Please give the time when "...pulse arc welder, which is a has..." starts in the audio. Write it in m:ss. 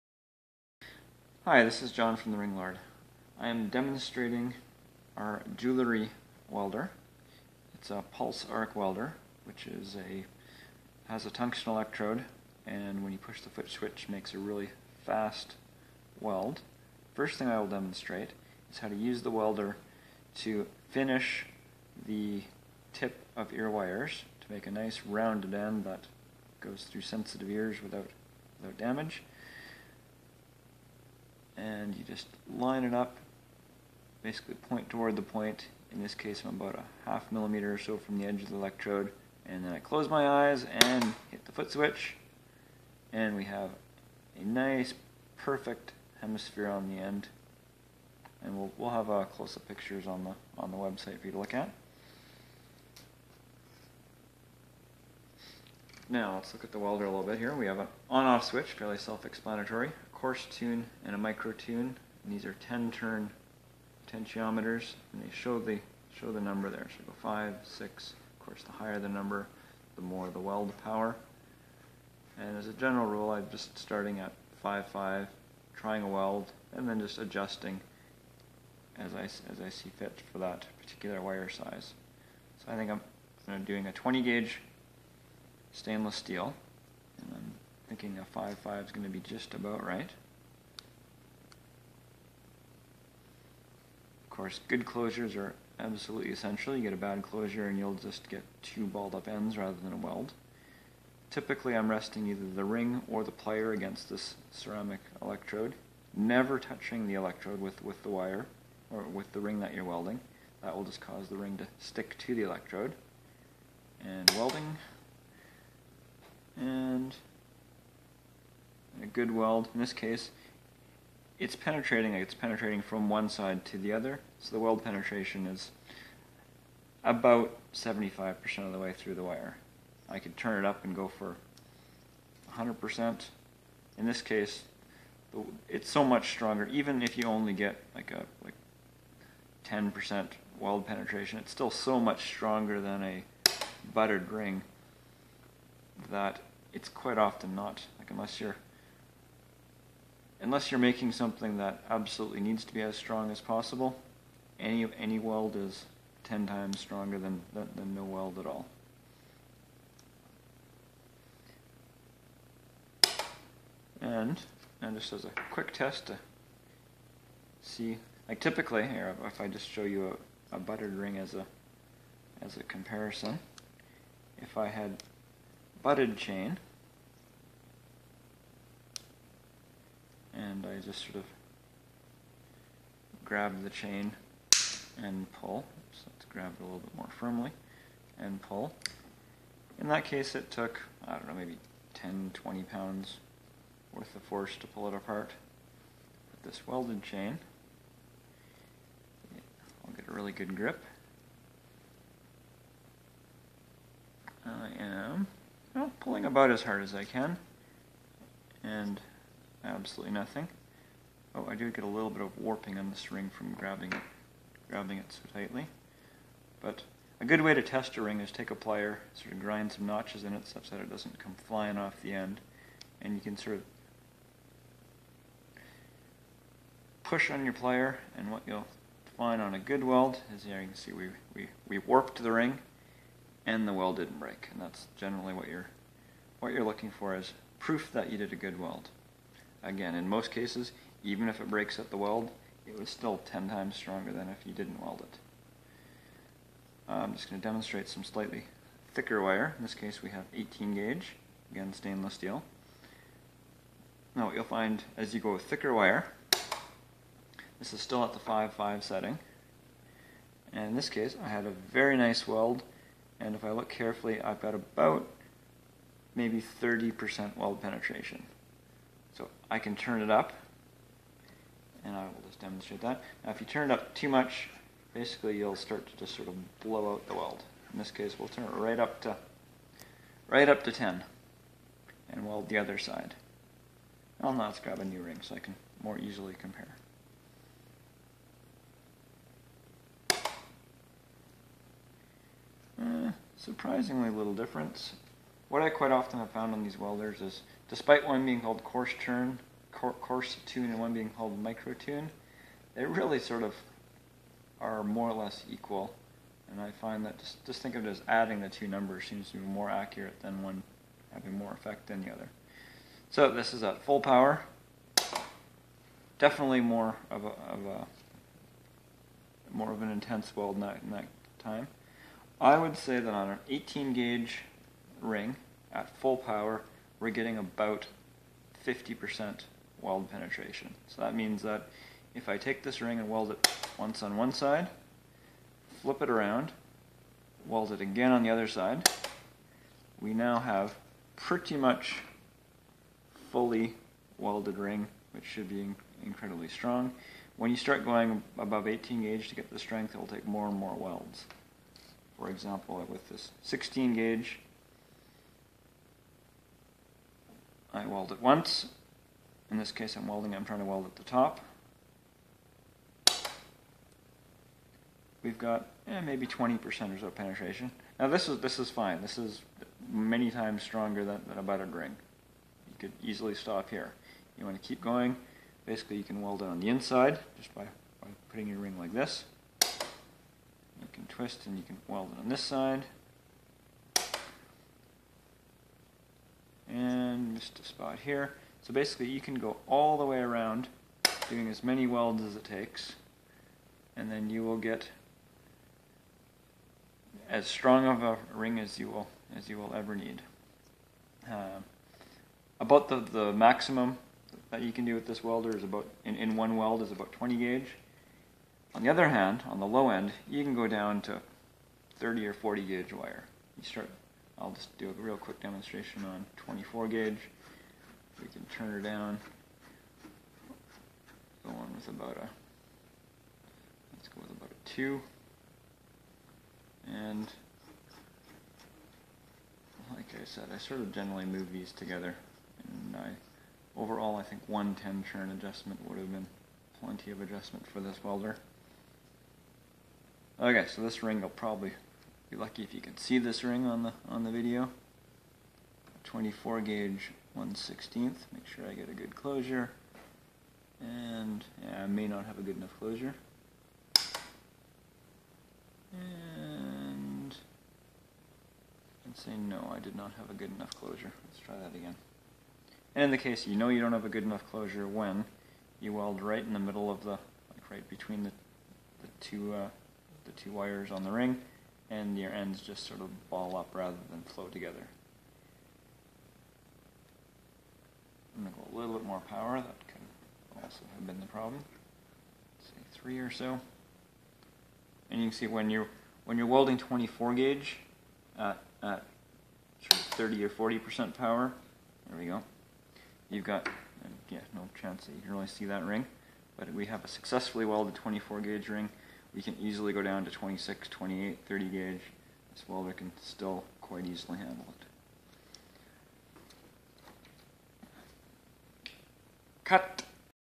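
0:08.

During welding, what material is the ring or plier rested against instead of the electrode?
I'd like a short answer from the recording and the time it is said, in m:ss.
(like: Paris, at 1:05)
ceramic, at 1:44.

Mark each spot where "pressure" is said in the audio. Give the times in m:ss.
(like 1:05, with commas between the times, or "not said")
not said.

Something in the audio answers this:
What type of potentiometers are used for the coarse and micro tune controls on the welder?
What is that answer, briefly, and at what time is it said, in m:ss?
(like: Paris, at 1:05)
10 turn, at 1:02.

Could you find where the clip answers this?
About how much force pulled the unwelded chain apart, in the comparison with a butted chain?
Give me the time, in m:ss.
3:11.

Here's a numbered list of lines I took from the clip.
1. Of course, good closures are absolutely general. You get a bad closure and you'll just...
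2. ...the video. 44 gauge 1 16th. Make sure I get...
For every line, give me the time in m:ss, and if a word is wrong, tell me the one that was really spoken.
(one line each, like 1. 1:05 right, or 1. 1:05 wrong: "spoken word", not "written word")
1. 1:34 wrong: "essential", not "general"
2. 7:24 wrong: "24", not "44".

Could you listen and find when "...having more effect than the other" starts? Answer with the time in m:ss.
5:11.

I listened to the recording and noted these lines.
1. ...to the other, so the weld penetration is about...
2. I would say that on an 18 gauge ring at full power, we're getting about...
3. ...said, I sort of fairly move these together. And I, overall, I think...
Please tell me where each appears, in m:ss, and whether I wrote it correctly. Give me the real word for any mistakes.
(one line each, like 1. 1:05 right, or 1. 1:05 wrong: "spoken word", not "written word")
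1. 2:03 right
2. 5:22 right
3. 7:10 wrong: "generally", not "fairly".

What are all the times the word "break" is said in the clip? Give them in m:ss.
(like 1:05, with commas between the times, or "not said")
3:54, 4:01.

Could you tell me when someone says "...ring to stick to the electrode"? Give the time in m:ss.
1:51.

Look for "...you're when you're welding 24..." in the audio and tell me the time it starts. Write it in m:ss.
8:05.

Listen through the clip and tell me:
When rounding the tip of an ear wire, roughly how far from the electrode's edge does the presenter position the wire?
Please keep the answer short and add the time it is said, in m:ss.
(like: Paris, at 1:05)
half millimeter, at 0:36.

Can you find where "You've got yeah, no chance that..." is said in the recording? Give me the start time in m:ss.
8:13.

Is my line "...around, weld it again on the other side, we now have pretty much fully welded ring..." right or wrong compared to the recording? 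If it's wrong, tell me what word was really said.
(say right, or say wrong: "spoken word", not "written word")
right.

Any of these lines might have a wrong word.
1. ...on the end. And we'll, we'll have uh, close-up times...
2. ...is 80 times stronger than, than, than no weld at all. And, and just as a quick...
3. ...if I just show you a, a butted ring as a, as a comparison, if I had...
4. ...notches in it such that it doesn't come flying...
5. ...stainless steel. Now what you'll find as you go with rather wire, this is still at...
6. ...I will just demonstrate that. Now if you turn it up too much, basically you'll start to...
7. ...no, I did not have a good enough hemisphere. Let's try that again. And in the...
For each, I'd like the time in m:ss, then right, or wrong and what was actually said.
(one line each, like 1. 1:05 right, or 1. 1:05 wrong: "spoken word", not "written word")
1. 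0:46 wrong: "pictures", not "times"
2. 2:35 wrong: "10", not "80"
3. 2:49 right
4. 3:39 right
5. 4:11 wrong: "thicker", not "rather"
6. 4:31 right
7. 7:39 wrong: "closure", not "hemisphere".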